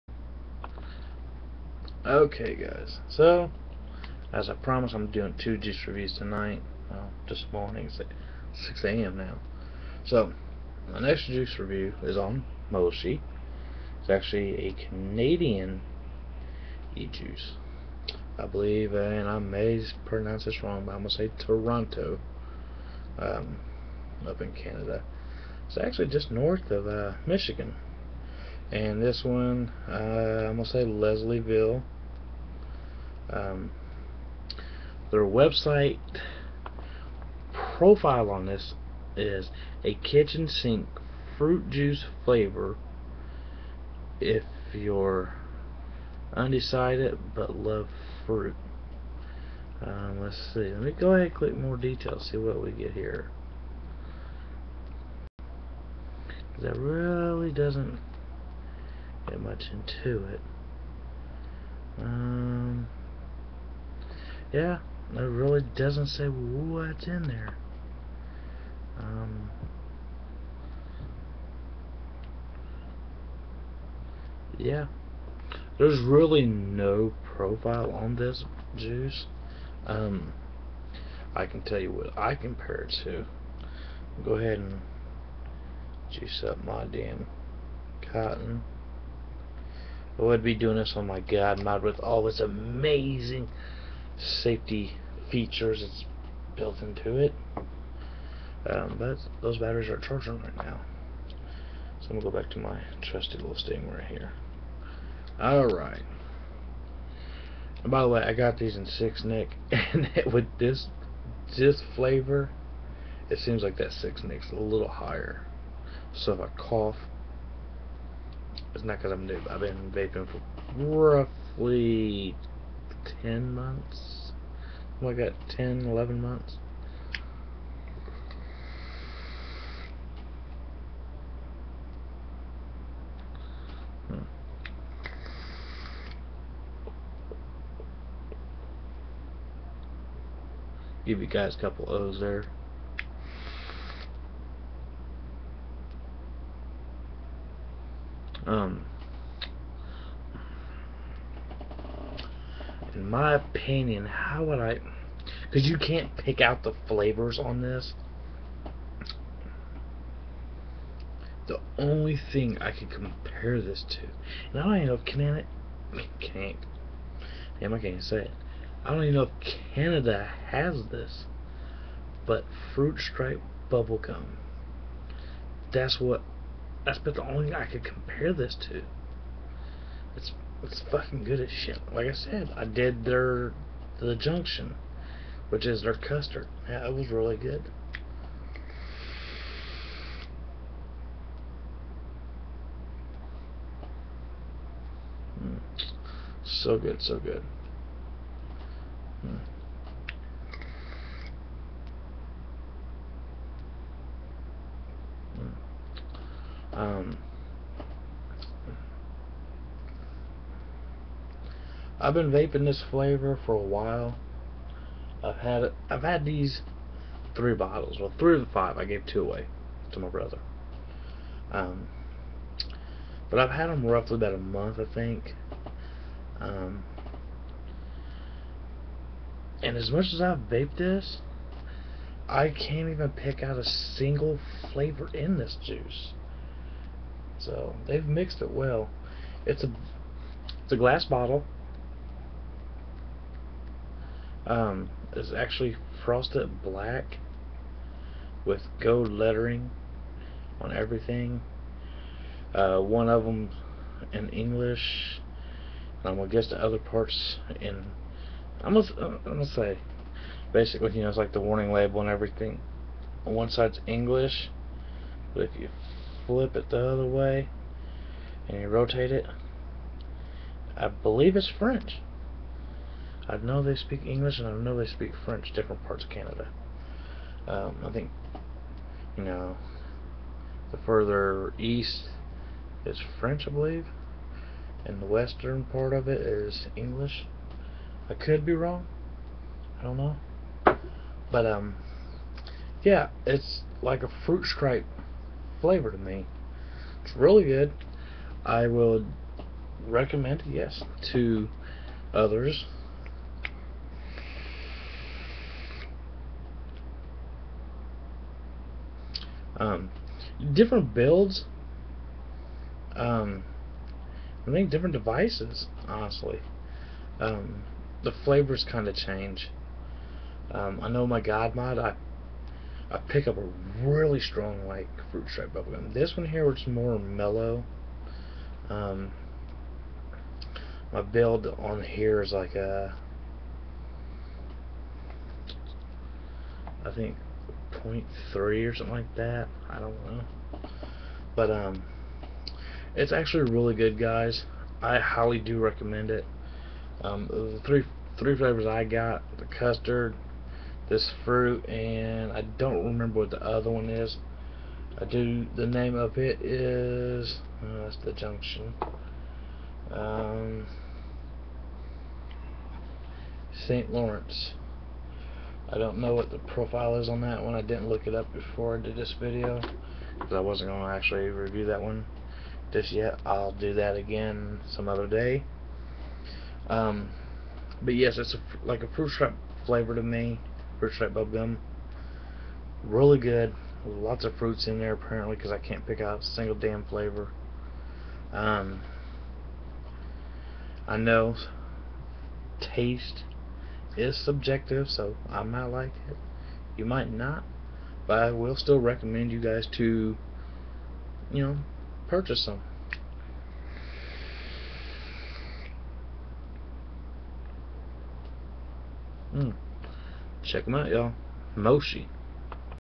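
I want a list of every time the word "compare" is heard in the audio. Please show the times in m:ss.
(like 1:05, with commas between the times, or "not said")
1:22, 2:42, 2:57.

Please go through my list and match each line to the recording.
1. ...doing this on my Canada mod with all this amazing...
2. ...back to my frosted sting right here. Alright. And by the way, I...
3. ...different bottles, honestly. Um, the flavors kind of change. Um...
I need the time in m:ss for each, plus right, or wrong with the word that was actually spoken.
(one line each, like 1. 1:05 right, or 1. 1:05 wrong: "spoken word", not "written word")
1. 1:30 wrong: "God", not "Canada"
2. 1:42 wrong: "trusted", not "frosted"
3. 5:14 wrong: "devices", not "bottles".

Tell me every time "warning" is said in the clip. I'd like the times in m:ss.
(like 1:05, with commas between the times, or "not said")
4:21.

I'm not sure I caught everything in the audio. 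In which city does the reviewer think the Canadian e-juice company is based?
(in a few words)
Toronto.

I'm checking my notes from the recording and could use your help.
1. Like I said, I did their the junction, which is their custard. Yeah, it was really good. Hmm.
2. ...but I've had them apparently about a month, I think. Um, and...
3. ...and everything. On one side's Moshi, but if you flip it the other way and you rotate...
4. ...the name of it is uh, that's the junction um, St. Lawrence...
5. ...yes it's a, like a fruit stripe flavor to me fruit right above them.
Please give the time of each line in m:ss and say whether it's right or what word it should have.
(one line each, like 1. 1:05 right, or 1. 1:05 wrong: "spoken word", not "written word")
1. 3:01 right
2. 3:43 wrong: "roughly", not "apparently"
3. 4:22 wrong: "English", not "Moshi"
4. 5:55 right
5. 6:17 right.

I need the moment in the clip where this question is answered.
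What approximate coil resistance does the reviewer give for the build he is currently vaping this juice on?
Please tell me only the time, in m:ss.
5:37.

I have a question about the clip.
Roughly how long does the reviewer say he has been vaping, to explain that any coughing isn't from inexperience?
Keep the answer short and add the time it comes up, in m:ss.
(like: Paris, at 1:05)
10 months, at 2:00.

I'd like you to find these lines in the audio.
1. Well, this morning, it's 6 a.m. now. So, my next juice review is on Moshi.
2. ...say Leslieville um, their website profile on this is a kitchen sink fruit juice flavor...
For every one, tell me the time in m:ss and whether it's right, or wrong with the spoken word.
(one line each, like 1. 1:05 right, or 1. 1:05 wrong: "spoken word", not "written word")
1. 0:06 right
2. 0:30 right.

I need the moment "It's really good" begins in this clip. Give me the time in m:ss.
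4:57.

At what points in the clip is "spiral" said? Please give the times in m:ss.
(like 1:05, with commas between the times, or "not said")
not said.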